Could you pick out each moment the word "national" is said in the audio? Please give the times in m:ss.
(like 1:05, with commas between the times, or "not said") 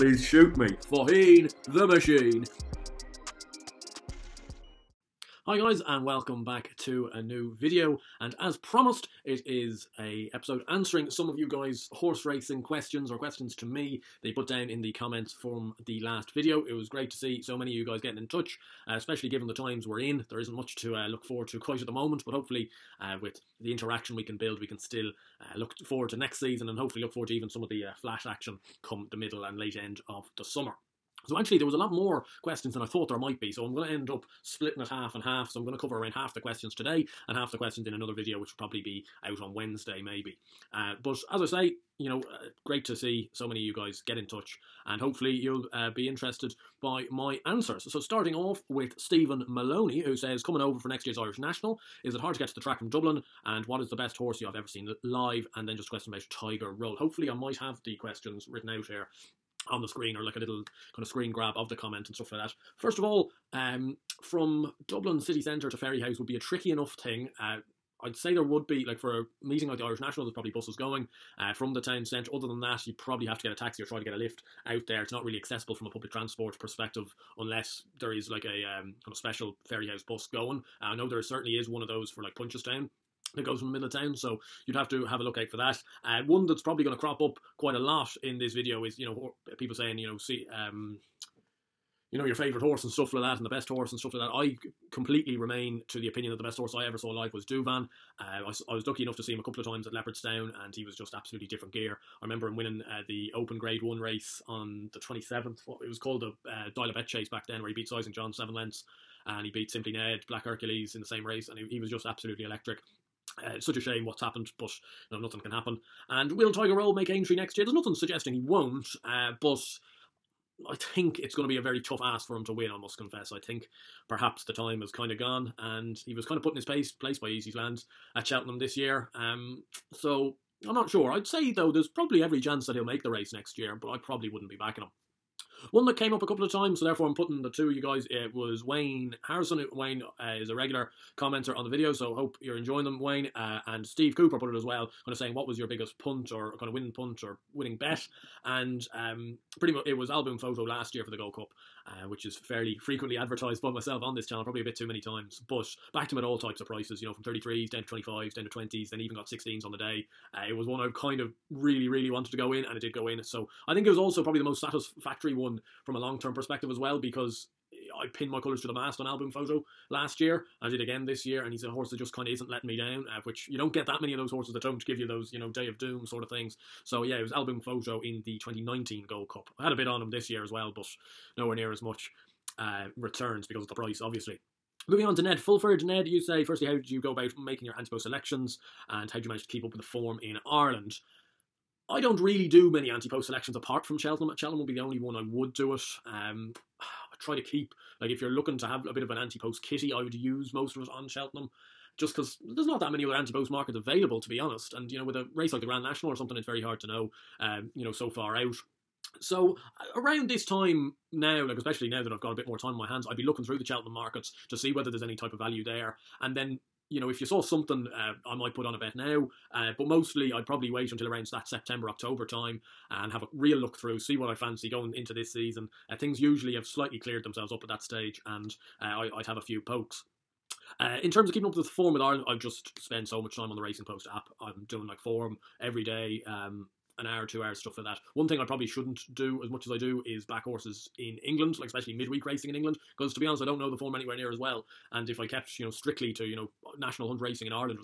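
0:51, 1:09, 3:25, 4:06.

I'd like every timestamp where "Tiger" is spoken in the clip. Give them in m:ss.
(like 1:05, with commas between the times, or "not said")
0:56, 1:56.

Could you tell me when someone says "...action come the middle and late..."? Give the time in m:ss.
0:28.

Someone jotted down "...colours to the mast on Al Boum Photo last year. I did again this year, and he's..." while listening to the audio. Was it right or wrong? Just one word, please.
right.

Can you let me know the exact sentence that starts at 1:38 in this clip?
Uh, I, I, was lucky enough to see him a couple of times at Leopardstown, and he was just absolutely different gear.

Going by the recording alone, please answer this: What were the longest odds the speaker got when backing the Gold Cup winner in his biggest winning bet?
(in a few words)
33s.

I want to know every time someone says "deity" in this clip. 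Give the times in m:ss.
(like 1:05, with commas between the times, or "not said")
not said.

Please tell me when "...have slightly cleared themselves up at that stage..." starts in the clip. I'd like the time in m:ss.
3:46.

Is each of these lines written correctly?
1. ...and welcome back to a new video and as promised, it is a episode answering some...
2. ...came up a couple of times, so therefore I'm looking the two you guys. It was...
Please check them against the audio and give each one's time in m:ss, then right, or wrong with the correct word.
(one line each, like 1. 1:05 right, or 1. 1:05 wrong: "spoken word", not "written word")
1. 0:05 right
2. 2:15 wrong: "putting", not "looking".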